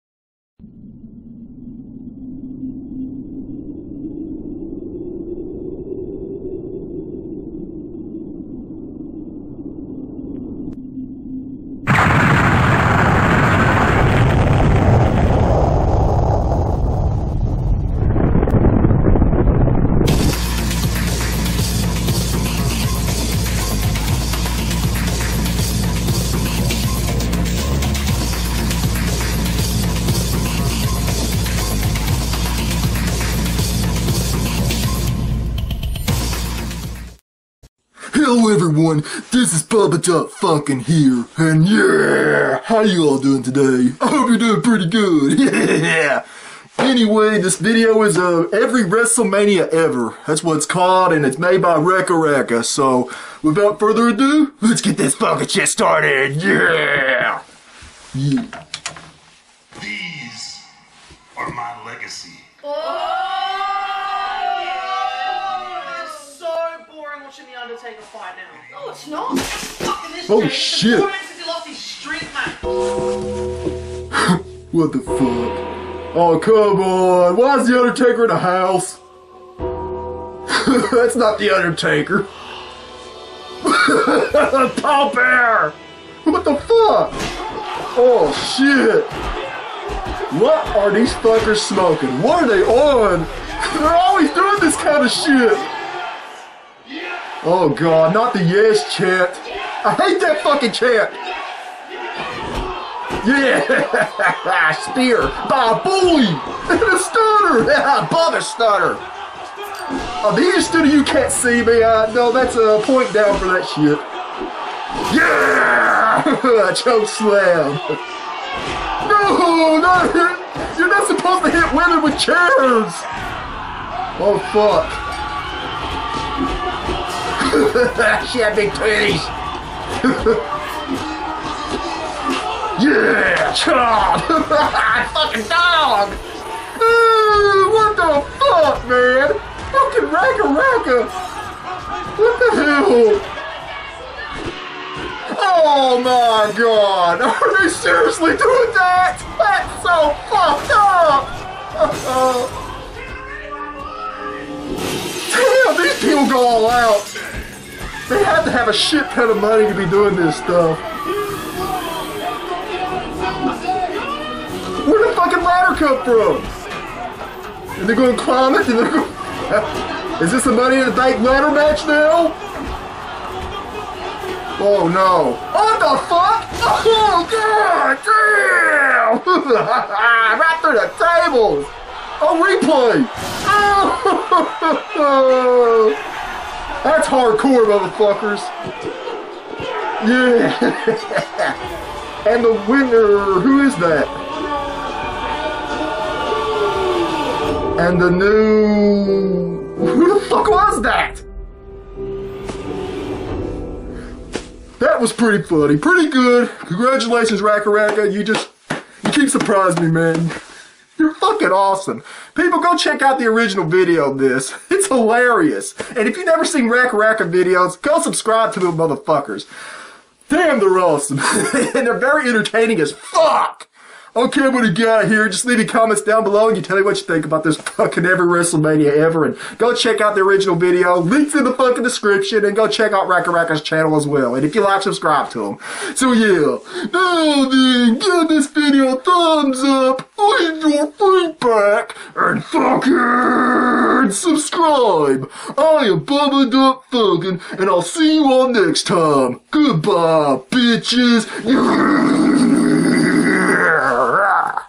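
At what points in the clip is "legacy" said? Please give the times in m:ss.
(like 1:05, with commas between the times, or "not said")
1:01.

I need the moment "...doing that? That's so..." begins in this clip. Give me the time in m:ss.
2:28.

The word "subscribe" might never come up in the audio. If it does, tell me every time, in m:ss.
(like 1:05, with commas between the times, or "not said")
3:38, 3:54.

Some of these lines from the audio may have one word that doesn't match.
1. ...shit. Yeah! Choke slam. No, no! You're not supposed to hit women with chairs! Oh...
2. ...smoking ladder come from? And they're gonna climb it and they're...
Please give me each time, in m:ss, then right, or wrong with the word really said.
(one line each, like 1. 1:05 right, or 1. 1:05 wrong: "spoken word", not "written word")
1. 1:53 right
2. 2:45 wrong: "fucking", not "smoking".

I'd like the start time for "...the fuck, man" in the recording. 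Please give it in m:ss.
2:17.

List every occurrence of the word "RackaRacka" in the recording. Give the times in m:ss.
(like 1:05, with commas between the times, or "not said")
3:27, 3:36, 3:53.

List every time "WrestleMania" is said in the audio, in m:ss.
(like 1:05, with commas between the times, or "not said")
0:48, 3:48.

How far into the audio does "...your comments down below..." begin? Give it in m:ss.
3:45.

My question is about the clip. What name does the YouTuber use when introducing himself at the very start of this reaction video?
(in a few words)
Bubba Dunk Funkin.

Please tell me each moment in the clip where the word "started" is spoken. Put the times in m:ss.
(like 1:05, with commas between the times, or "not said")
0:55.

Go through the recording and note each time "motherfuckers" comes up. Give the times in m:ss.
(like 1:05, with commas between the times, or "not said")
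3:07, 3:38.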